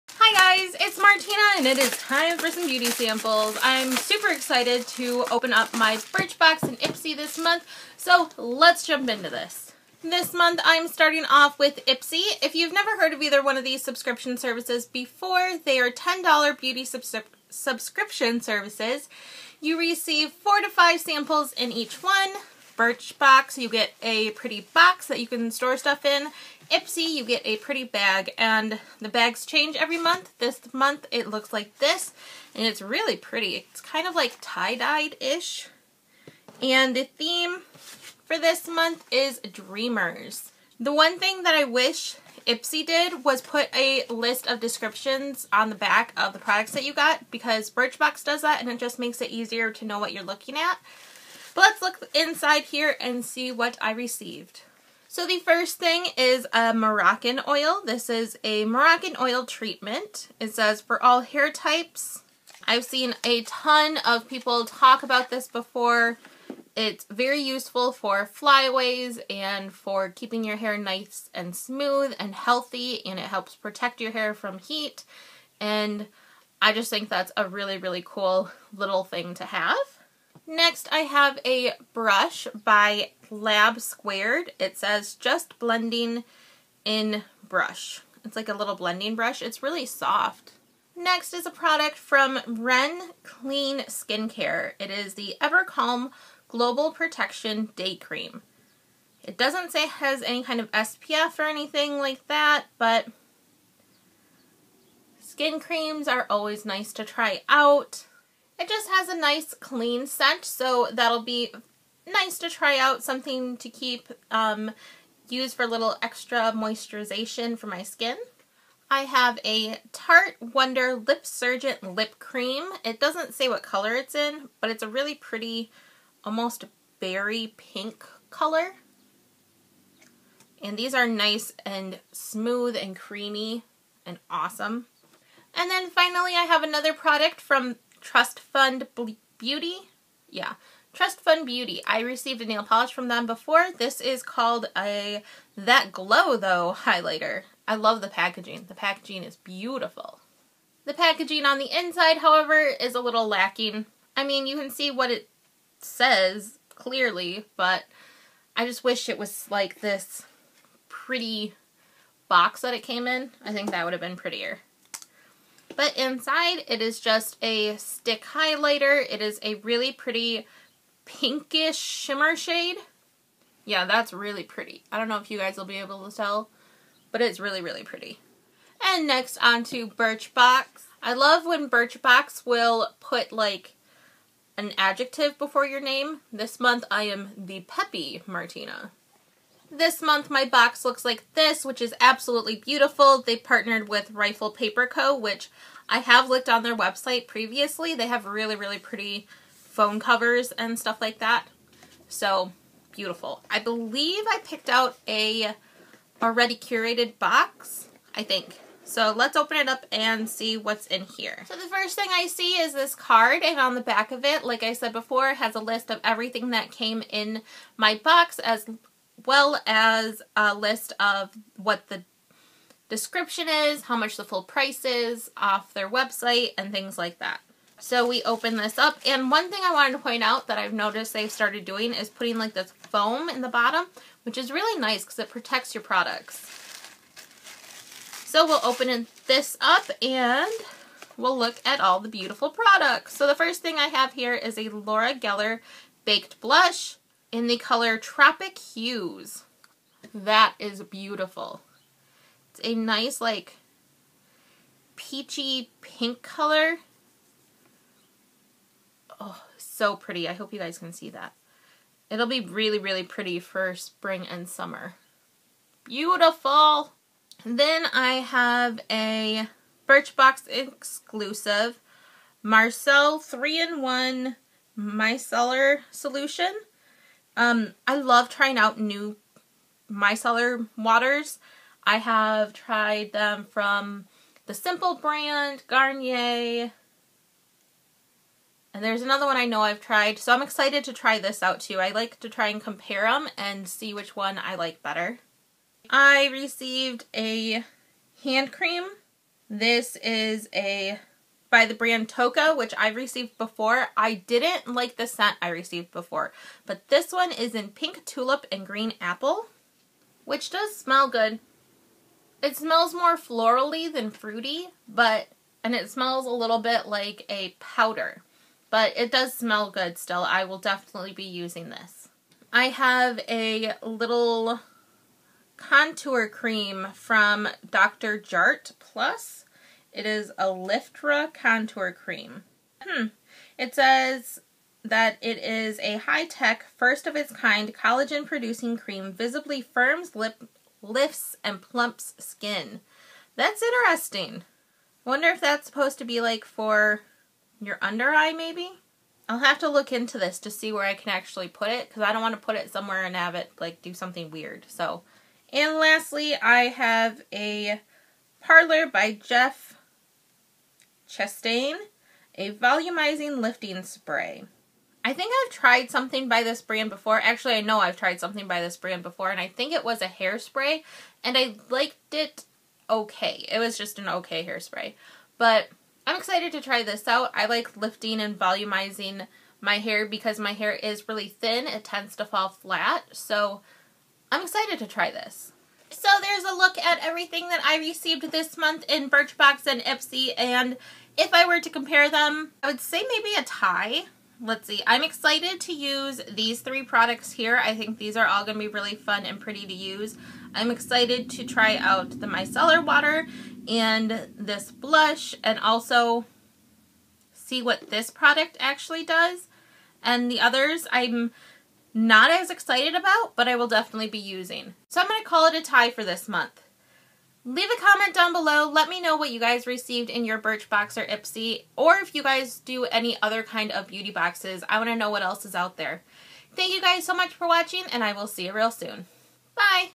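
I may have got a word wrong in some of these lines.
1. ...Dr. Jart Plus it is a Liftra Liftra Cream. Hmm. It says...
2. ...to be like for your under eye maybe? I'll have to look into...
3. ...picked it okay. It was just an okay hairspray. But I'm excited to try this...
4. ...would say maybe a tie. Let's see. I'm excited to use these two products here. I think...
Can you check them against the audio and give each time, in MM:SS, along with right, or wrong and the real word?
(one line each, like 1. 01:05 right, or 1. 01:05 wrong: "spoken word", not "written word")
1. 05:27 wrong: "Contour", not "Liftra"
2. 05:45 right
3. 06:11 wrong: "liked", not "picked"
4. 06:32 wrong: "three", not "two".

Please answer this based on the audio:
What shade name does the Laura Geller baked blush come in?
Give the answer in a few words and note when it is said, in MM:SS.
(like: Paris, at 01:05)
Tropic Hues, at 04:07.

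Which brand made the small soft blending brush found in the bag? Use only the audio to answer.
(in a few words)
Lab Squared.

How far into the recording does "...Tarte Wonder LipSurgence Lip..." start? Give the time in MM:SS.
01:59.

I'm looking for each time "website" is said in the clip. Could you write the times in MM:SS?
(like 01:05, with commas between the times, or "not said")
03:16, 03:45.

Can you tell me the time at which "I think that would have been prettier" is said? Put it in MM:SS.
02:43.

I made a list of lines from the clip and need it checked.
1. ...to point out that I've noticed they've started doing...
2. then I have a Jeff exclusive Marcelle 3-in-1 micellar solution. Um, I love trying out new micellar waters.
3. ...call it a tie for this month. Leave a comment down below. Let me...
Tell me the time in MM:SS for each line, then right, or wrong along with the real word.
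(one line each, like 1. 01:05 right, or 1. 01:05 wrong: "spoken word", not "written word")
1. 03:49 right
2. 04:27 wrong: "Birchbox", not "Jeff"
3. 06:55 right.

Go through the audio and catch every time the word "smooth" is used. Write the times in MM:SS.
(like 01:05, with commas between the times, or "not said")
01:11, 02:12.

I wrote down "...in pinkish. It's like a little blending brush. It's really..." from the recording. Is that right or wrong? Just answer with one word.
wrong.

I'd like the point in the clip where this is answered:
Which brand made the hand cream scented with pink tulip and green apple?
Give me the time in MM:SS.
05:02.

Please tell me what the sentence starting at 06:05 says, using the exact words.
I think I've tried something by this brand before.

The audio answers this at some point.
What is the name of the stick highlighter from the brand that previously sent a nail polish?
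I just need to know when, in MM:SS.
02:25.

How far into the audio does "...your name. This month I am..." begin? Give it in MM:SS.
03:05.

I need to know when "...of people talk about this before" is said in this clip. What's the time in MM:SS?
01:04.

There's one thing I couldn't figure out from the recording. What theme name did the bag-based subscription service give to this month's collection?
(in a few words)
Dreamers.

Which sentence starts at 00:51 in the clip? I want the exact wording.
But let's look inside here and see what I received.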